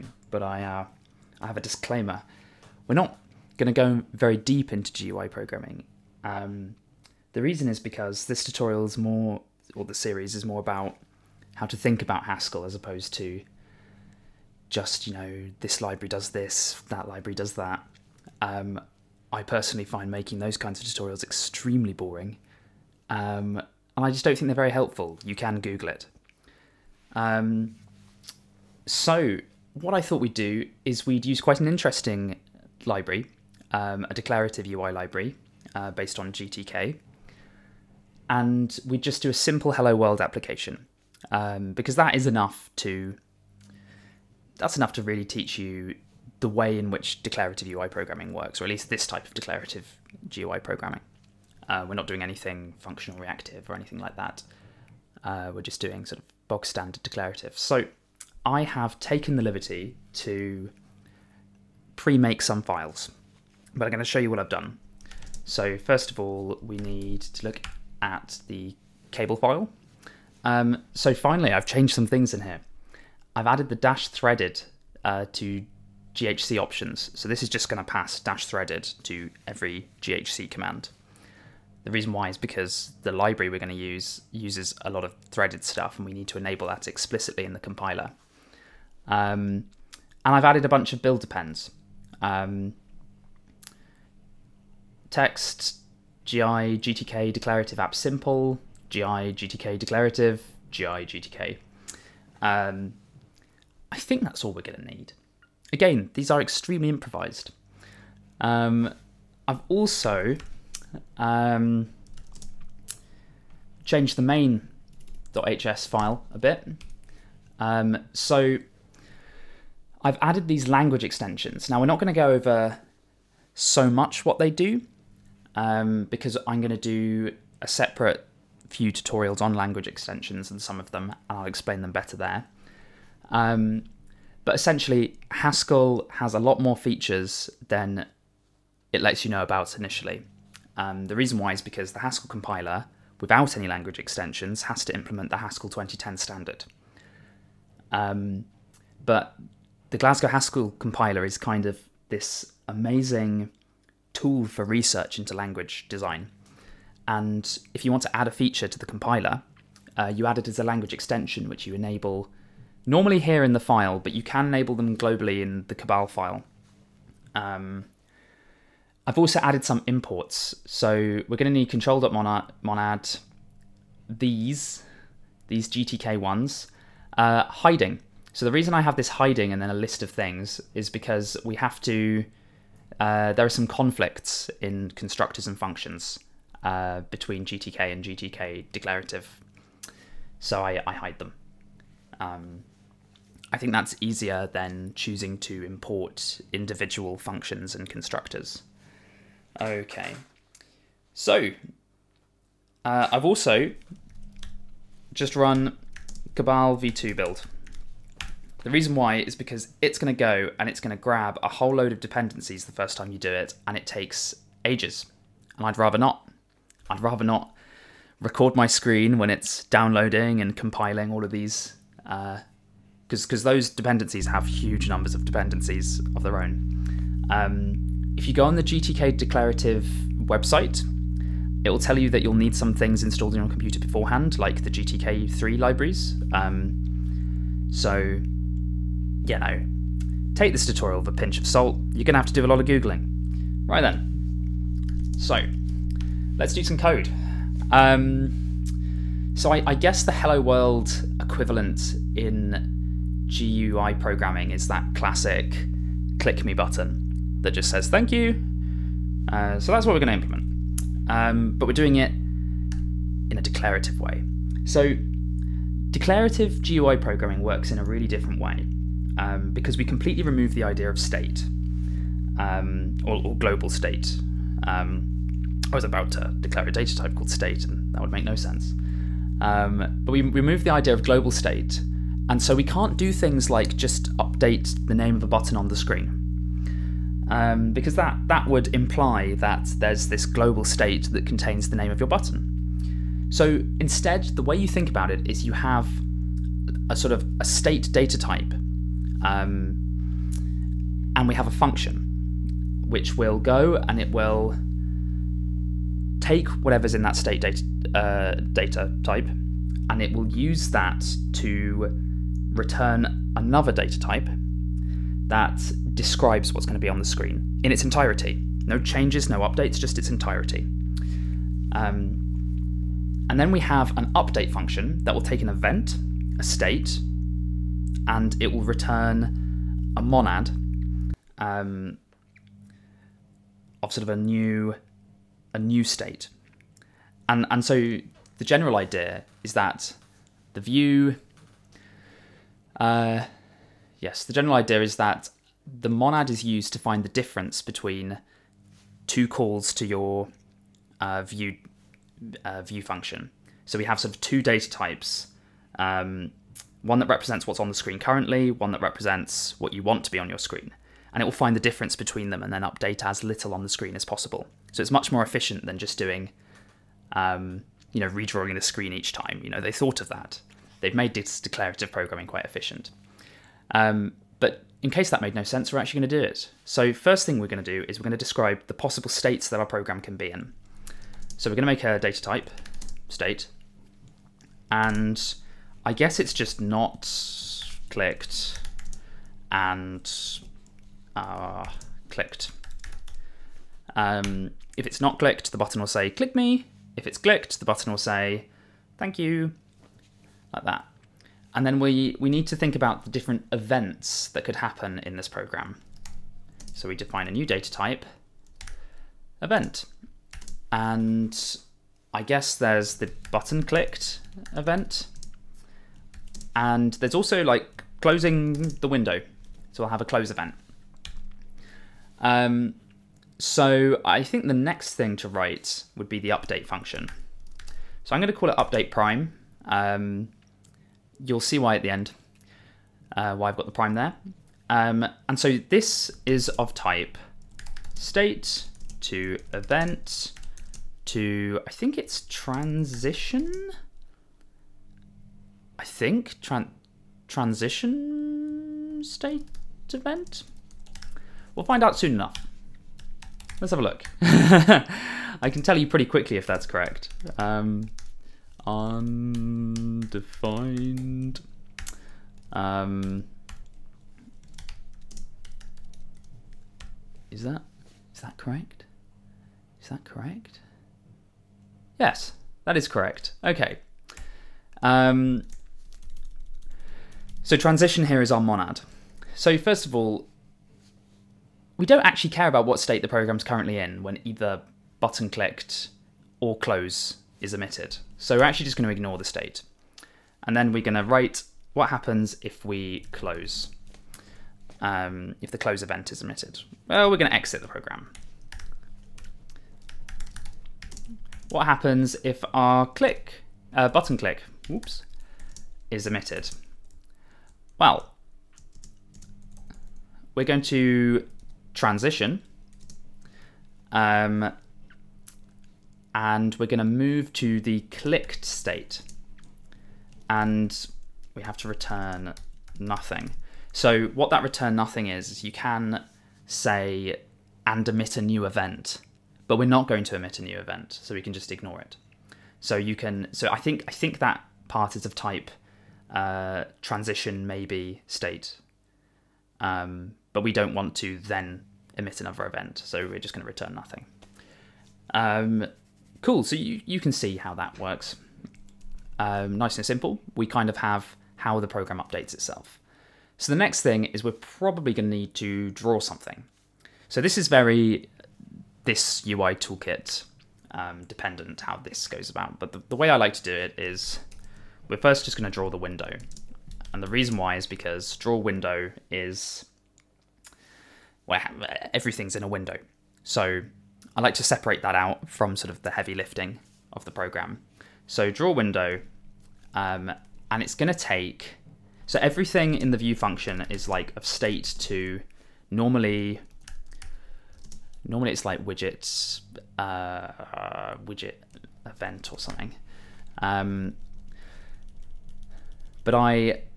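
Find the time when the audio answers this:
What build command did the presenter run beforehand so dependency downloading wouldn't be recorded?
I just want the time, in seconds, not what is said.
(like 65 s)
206 s.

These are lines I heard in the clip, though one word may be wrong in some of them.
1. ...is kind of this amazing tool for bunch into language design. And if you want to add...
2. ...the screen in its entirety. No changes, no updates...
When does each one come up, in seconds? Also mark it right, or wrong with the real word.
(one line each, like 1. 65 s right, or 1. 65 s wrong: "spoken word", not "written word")
1. 151 s wrong: "research", not "bunch"
2. 316 s right.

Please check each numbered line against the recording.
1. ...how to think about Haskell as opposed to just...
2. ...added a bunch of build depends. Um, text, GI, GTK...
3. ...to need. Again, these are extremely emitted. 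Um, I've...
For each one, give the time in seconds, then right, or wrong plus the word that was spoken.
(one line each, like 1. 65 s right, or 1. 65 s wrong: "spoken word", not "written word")
1. 11 s right
2. 90 s right
3. 104 s wrong: "improvised", not "emitted".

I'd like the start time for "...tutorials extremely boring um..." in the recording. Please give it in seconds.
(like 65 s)
20 s.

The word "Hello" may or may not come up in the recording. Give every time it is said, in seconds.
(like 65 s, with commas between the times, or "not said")
39 s, 250 s.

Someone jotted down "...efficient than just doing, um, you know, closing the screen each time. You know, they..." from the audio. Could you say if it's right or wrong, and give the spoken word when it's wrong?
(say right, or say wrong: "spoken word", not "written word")
wrong: "redrawing", not "closing".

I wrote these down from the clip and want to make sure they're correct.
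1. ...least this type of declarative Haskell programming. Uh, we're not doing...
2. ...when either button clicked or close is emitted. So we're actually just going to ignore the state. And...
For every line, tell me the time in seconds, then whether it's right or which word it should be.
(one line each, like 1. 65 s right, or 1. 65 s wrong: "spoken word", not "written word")
1. 48 s wrong: "GUI", not "Haskell"
2. 484 s right.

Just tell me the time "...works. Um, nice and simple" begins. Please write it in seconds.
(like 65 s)
547 s.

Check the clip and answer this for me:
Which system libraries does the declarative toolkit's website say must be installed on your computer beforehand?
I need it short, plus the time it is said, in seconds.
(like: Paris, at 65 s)
GTK3 libraries, at 234 s.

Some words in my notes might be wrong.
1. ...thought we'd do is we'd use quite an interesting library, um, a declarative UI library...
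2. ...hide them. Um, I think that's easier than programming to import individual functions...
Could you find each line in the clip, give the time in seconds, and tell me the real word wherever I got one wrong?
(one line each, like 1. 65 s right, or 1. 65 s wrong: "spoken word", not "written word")
1. 30 s right
2. 190 s wrong: "choosing", not "programming".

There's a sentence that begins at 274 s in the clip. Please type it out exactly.
Um, I was about to declare a data type called state and that would make no sense.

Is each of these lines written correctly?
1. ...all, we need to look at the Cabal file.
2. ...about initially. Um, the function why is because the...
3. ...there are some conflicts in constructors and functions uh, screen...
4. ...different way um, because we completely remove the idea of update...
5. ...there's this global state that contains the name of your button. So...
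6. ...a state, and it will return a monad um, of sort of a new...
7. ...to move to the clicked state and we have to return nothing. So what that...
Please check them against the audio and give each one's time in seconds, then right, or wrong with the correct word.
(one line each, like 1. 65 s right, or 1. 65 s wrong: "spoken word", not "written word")
1. 66 s right
2. 139 s wrong: "reason", not "function"
3. 183 s wrong: "between", not "screen"
4. 268 s wrong: "state", not "update"
5. 289 s right
6. 326 s right
7. 516 s right.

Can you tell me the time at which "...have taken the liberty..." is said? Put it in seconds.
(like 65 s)
58 s.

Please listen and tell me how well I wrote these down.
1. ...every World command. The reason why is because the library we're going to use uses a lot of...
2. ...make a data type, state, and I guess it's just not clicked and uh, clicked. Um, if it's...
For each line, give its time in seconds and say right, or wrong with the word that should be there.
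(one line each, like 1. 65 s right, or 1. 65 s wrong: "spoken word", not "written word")
1. 79 s wrong: "GHC", not "World"
2. 381 s right.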